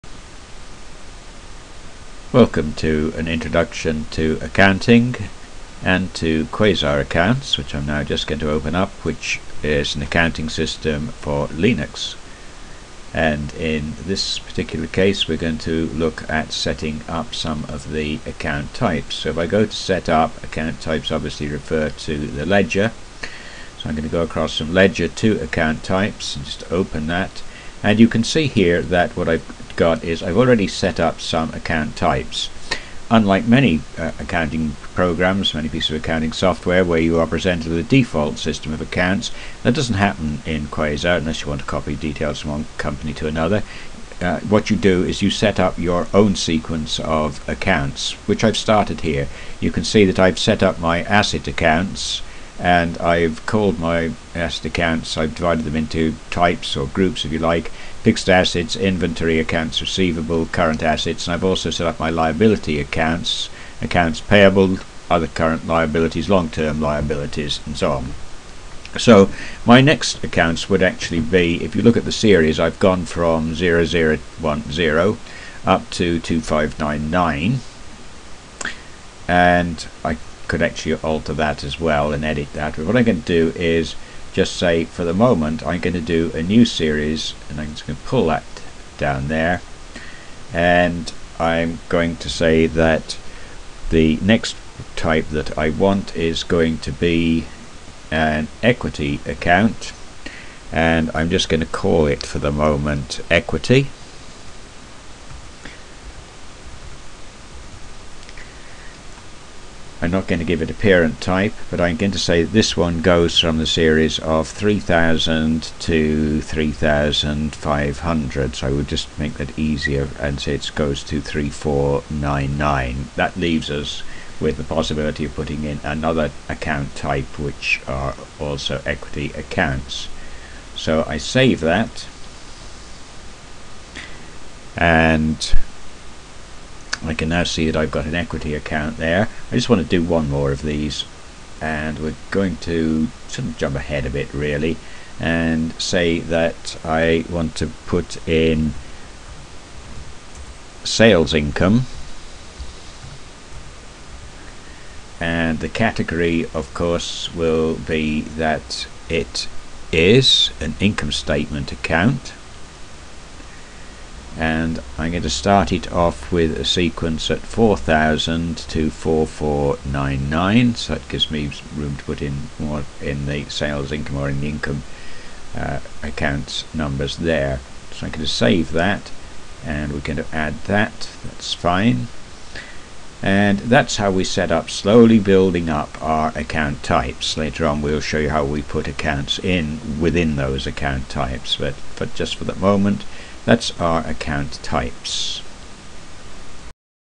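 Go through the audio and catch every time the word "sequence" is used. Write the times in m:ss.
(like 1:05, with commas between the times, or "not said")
0:46, 2:46.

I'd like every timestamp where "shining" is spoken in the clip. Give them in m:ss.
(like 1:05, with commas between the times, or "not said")
not said.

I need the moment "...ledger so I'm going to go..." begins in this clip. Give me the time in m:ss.
0:22.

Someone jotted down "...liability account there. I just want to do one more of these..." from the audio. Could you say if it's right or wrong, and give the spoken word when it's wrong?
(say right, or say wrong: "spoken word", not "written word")
wrong: "equity", not "liability".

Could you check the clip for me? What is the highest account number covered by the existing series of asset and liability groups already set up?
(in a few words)
2599.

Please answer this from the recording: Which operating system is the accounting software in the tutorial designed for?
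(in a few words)
Linux.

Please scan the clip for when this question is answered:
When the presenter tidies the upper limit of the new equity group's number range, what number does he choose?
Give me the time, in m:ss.
2:01.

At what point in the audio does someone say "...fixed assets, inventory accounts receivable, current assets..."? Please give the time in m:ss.
0:58.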